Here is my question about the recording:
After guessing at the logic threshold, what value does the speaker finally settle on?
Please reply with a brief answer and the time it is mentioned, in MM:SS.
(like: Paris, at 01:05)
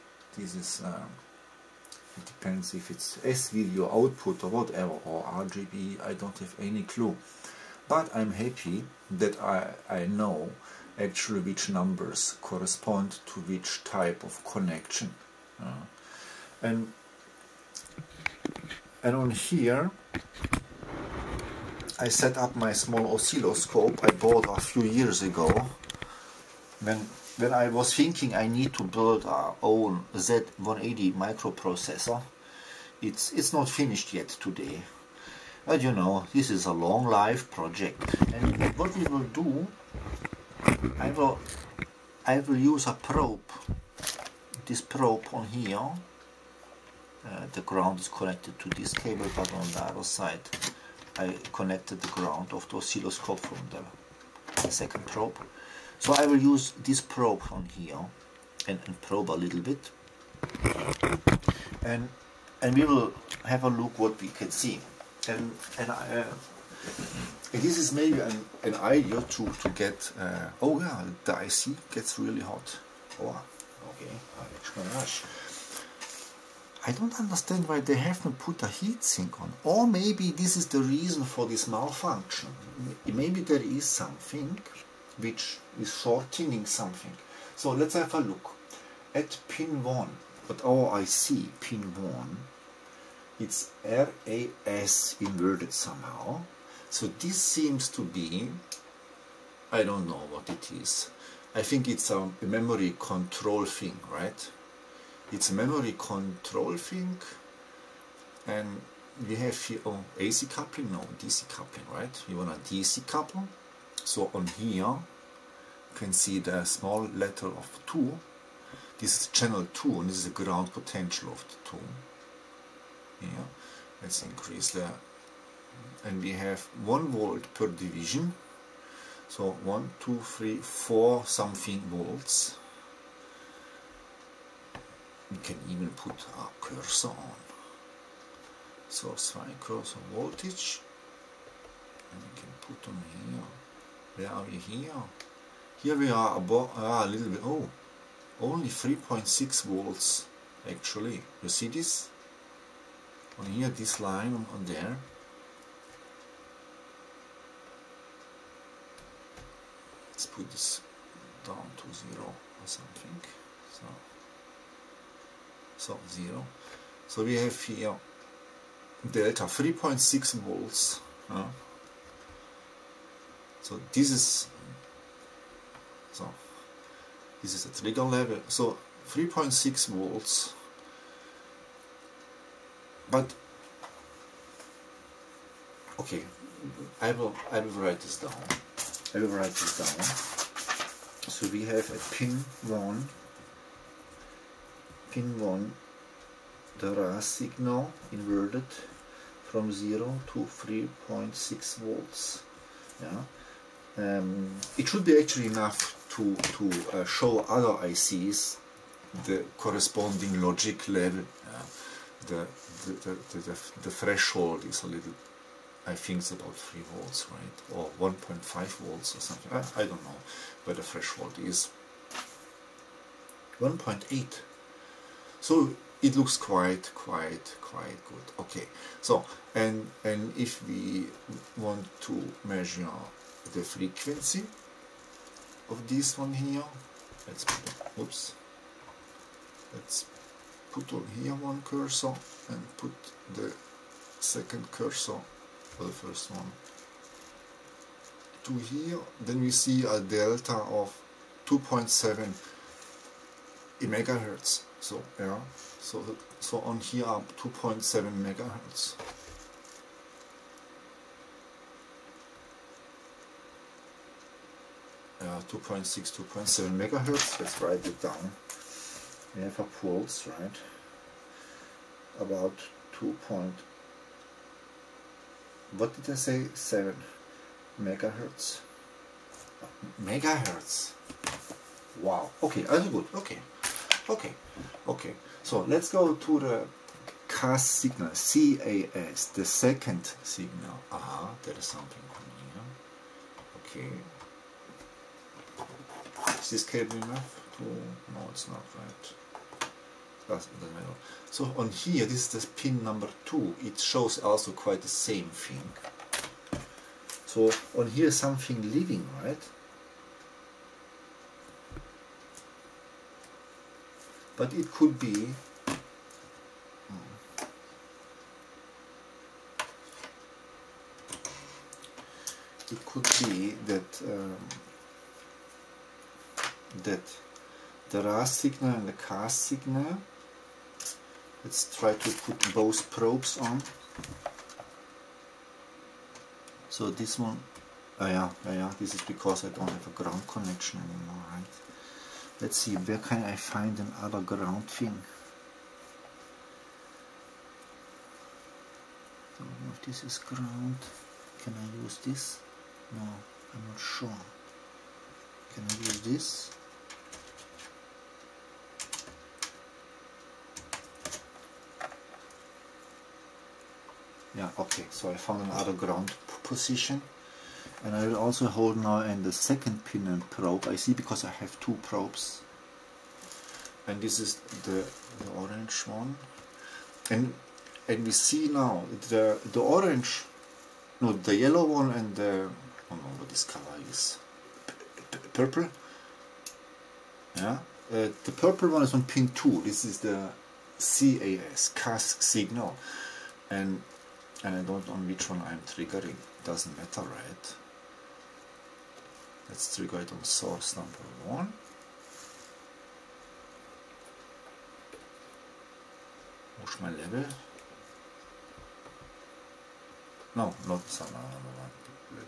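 1.8, at 03:43.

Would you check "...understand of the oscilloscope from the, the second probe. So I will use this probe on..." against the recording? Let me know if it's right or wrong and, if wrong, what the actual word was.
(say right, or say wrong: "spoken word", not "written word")
wrong: "ground", not "understand".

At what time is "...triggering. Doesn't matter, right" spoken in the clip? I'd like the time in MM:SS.
06:35.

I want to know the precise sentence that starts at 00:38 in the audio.
And what we will do, I will, I will use a probe, this probe on here.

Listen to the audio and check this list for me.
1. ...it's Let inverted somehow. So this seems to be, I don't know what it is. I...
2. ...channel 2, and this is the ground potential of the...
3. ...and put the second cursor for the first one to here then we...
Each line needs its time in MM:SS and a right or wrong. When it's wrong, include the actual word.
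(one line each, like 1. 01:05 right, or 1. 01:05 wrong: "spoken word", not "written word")
1. 01:33 wrong: "RAS", not "Let"
2. 01:59 right
3. 04:02 right.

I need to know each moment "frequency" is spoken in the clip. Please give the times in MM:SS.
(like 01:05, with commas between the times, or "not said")
03:53.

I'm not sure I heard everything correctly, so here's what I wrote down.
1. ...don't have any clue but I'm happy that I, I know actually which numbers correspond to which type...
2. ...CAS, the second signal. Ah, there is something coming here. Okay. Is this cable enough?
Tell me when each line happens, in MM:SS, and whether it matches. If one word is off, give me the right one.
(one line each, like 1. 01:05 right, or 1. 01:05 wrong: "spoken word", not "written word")
1. 00:06 right
2. 04:48 right.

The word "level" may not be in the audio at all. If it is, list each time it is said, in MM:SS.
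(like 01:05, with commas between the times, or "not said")
02:58, 03:30, 06:46.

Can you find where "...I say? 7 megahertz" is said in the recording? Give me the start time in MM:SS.
04:36.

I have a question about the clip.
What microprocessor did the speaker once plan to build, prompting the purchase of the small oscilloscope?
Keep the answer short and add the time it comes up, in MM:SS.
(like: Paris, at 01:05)
Z180, at 00:30.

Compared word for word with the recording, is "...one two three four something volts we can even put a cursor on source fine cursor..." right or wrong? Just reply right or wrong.
right.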